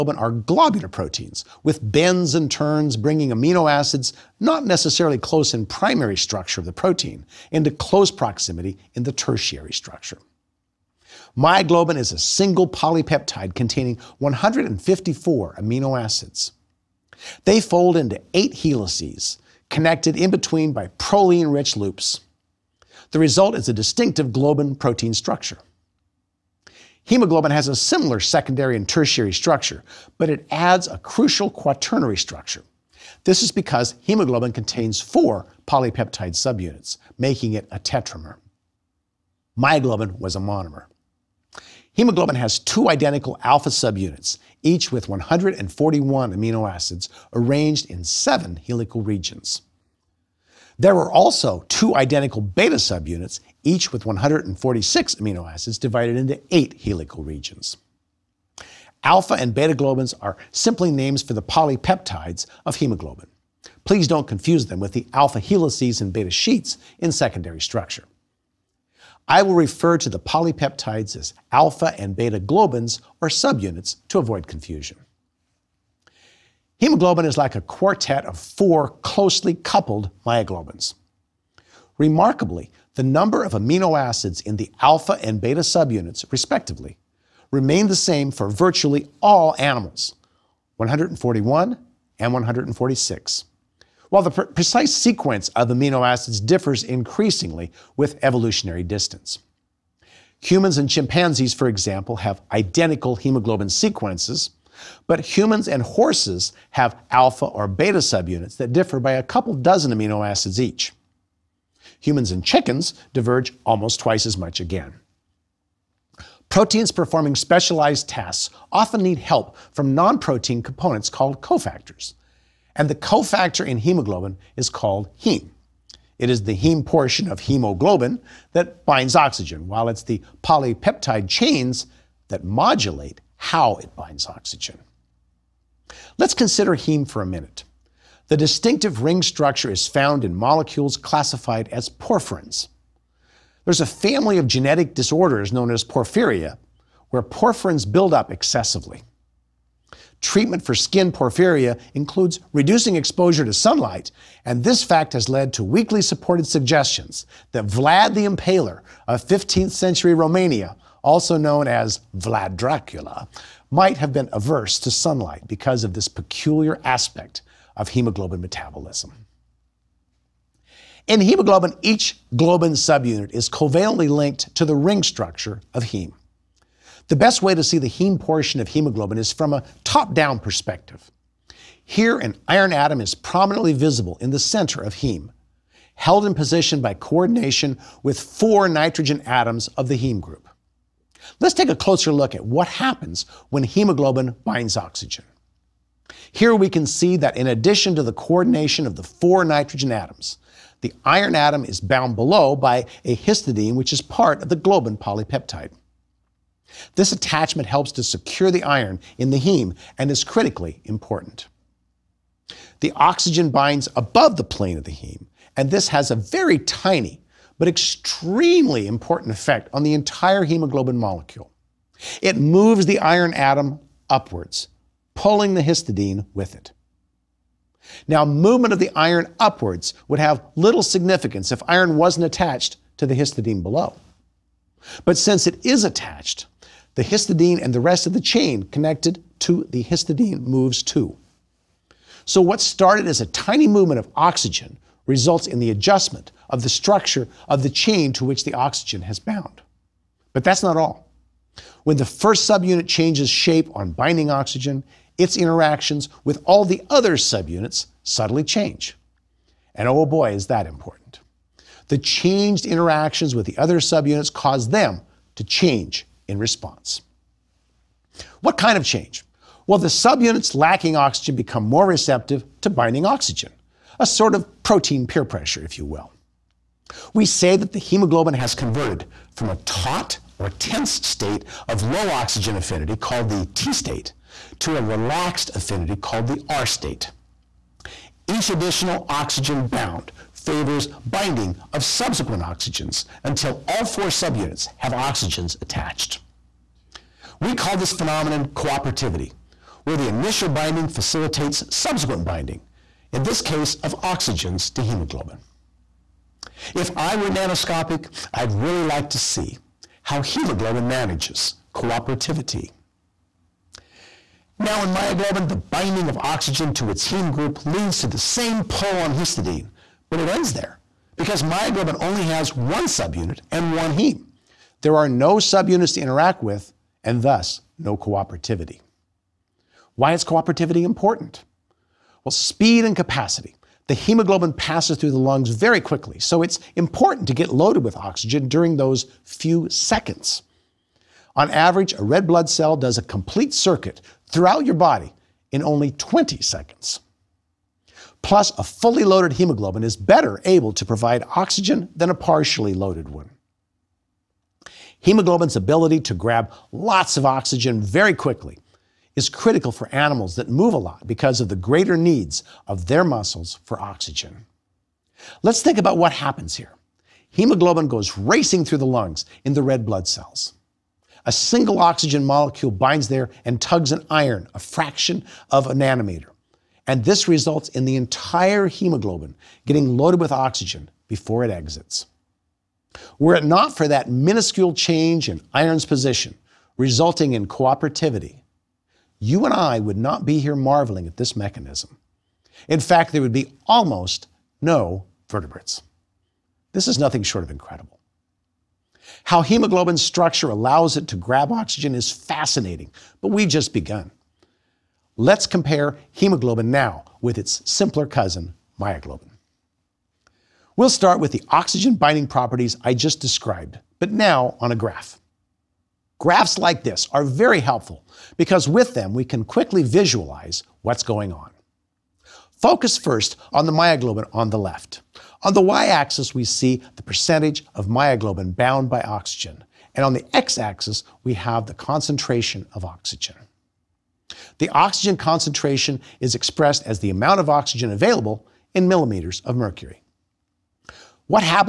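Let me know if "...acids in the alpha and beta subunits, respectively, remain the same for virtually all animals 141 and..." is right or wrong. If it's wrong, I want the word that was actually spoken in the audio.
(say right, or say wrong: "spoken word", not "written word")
right.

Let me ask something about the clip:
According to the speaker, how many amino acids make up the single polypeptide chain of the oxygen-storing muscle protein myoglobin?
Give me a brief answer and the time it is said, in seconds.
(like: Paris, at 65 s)
154, at 14 s.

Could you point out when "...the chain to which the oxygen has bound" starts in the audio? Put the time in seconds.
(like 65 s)
247 s.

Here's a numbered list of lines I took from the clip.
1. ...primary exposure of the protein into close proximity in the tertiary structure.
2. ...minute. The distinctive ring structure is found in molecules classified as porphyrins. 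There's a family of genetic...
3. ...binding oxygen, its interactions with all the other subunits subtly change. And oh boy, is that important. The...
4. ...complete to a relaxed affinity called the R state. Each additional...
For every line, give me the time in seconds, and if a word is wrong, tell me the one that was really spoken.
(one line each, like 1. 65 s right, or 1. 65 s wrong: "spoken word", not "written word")
1. 5 s wrong: "structure", not "exposure"
2. 137 s right
3. 253 s right
4. 283 s wrong: "state", not "complete".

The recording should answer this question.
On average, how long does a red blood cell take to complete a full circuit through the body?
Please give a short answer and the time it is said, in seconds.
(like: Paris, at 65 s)
20 seconds, at 345 s.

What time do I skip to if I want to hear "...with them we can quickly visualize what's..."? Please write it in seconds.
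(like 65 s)
418 s.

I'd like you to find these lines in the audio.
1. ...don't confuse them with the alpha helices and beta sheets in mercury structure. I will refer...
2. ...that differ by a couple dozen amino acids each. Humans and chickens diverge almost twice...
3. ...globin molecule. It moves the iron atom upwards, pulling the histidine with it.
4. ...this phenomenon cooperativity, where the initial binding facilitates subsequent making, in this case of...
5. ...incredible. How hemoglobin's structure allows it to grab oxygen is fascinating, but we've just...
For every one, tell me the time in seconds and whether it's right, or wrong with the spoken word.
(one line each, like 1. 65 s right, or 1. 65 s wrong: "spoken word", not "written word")
1. 64 s wrong: "secondary", not "mercury"
2. 108 s right
3. 220 s wrong: "hemoglobin", not "globin"
4. 297 s wrong: "binding", not "making"
5. 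397 s right.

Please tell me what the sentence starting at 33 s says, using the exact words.
This is because hemoglobin contains four polypeptide subunits, making it a tetramer.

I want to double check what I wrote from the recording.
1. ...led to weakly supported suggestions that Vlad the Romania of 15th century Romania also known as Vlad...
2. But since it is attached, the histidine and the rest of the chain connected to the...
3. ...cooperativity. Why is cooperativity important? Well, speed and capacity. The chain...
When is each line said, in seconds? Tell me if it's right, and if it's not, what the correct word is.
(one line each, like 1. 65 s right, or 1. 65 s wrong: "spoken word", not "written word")
1. 155 s wrong: "Impaler", not "Romania"
2. 235 s right
3. 327 s wrong: "hemoglobin", not "chain".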